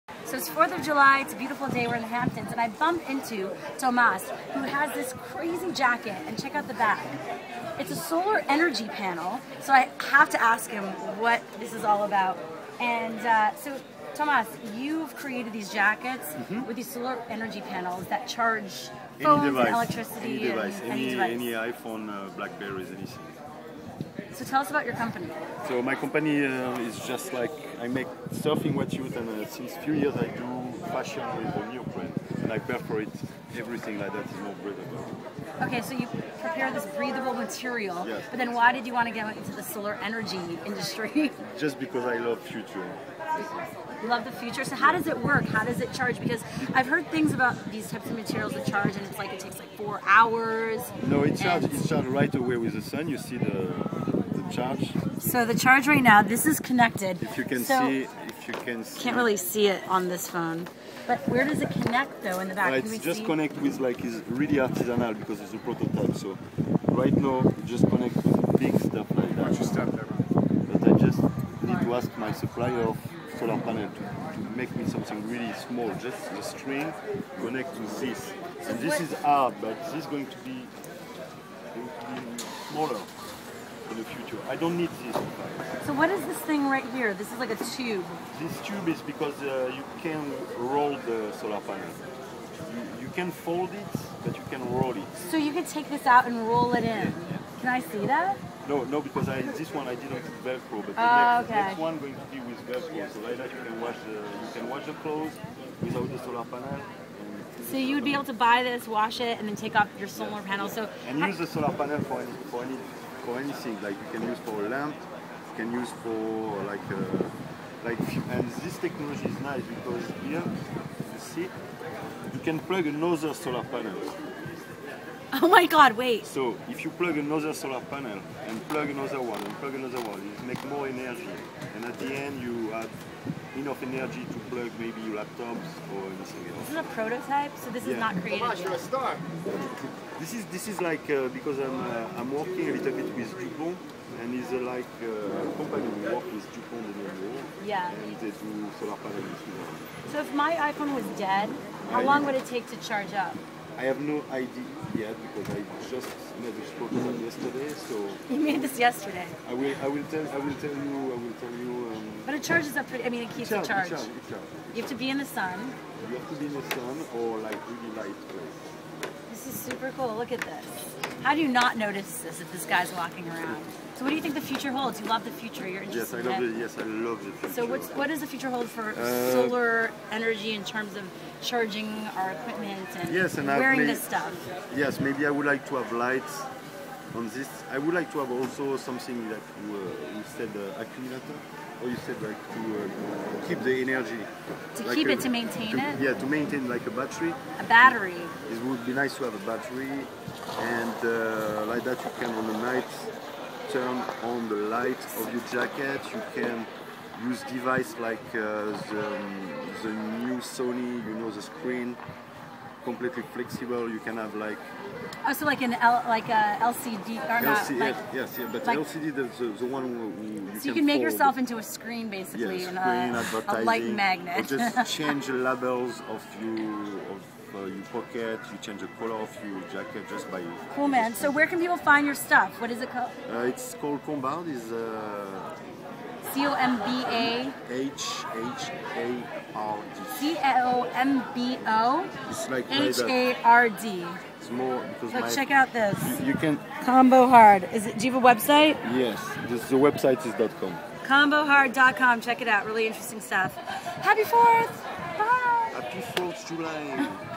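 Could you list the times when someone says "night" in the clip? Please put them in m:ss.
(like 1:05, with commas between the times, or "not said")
3:22.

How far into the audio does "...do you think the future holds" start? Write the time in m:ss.
2:54.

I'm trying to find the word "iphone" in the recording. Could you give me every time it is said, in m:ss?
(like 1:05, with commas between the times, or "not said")
0:21, 2:30.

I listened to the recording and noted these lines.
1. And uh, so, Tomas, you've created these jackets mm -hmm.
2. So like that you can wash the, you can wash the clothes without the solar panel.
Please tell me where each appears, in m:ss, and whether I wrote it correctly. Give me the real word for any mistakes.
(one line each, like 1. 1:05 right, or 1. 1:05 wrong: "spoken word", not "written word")
1. 0:12 right
2. 1:43 right.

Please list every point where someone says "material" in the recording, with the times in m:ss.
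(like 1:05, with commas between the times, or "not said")
0:37, 0:48.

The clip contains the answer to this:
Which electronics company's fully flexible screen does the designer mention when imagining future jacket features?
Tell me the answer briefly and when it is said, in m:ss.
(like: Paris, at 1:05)
Sony, at 3:30.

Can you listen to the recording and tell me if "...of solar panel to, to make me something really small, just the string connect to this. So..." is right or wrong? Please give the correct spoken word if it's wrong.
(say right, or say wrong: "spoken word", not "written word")
right.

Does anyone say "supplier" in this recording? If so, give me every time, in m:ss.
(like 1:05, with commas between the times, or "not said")
1:12.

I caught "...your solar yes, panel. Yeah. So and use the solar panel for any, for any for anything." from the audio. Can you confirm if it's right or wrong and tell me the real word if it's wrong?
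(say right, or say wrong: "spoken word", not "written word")
right.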